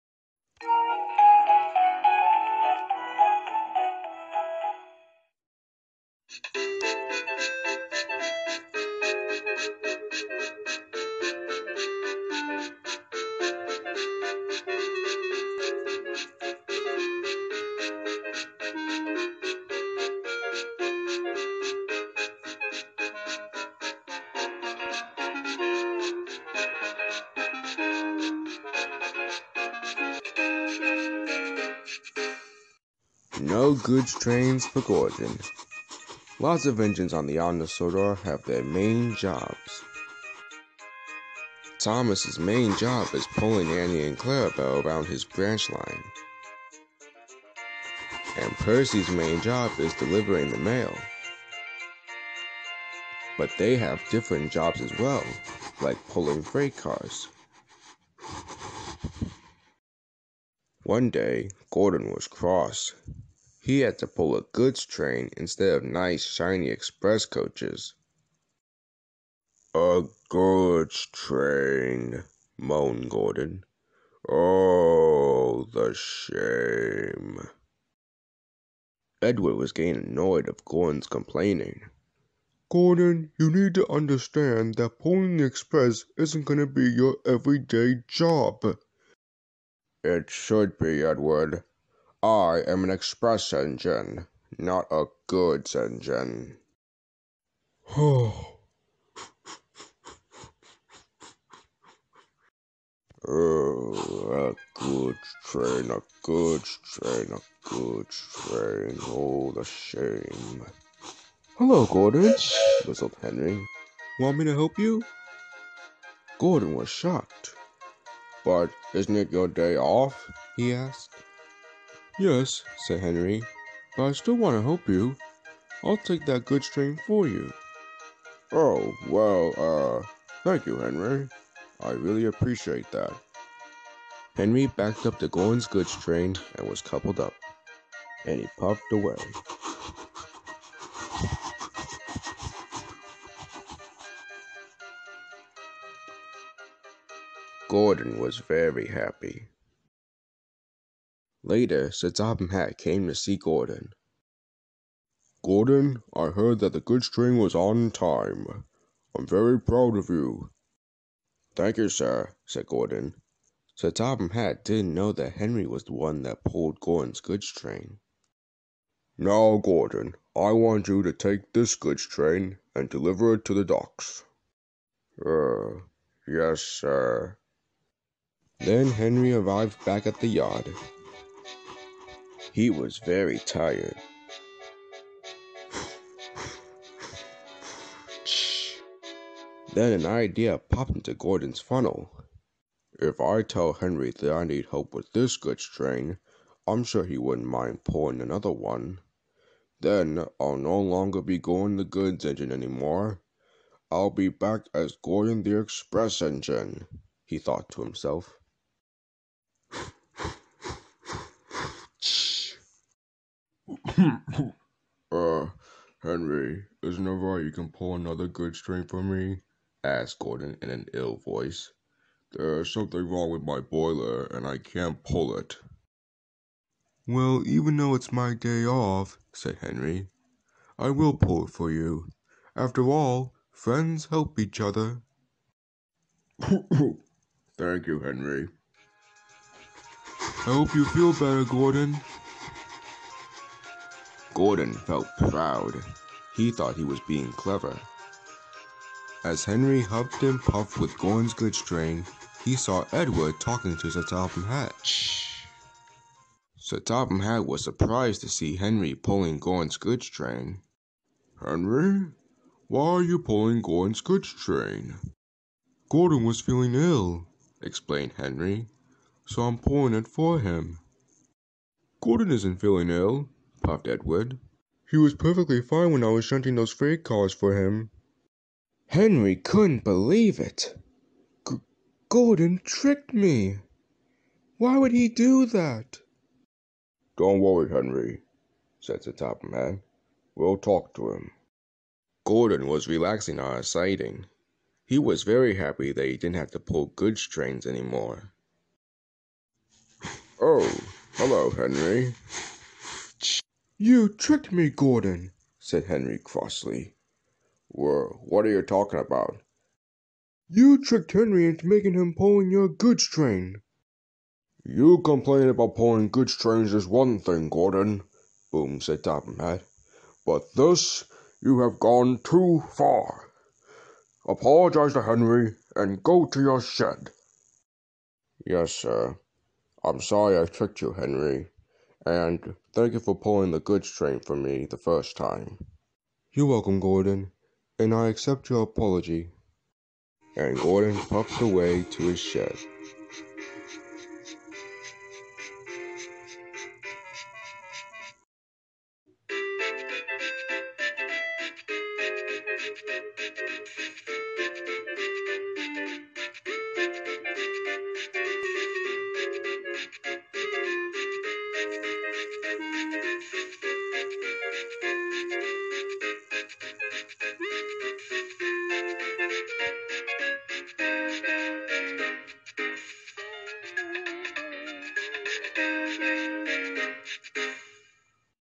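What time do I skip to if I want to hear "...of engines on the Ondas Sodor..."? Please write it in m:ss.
0:36.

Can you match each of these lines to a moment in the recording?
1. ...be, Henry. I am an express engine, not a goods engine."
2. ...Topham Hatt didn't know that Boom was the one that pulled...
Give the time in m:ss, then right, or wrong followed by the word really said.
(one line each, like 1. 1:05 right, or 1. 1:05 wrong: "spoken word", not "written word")
1. 1:30 wrong: "Edward", not "Henry"
2. 2:43 wrong: "Henry", not "Boom".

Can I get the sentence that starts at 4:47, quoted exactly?
Don't worry, Henry, said the top man.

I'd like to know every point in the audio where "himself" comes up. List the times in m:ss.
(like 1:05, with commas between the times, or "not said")
3:27.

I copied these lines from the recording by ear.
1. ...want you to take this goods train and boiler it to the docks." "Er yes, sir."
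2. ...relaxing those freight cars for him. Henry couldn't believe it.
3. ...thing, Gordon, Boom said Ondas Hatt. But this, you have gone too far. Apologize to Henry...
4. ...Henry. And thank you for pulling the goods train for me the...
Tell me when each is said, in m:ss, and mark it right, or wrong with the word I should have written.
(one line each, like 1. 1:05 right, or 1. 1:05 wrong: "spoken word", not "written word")
1. 2:50 wrong: "deliver", not "boiler"
2. 4:36 wrong: "shunting", not "relaxing"
3. 5:17 wrong: "Topham", not "Ondas"
4. 5:30 right.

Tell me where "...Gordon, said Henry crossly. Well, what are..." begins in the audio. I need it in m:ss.
5:04.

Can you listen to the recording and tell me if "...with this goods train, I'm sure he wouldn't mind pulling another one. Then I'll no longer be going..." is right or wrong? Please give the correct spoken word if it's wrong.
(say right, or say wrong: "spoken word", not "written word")
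right.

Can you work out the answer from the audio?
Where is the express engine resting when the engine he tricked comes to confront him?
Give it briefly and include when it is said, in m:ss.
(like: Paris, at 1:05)
a siding, at 4:53.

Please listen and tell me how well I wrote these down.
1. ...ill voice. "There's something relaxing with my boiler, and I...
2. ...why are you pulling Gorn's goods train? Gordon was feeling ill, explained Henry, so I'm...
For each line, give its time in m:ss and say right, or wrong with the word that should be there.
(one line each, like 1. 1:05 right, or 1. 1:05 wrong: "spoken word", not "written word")
1. 3:40 wrong: "wrong", not "relaxing"
2. 4:22 right.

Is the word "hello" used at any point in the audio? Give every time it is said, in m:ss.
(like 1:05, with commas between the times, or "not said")
1:51, 5:01.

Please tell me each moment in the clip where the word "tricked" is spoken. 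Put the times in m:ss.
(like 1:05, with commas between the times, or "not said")
4:42, 5:04, 5:10, 5:30.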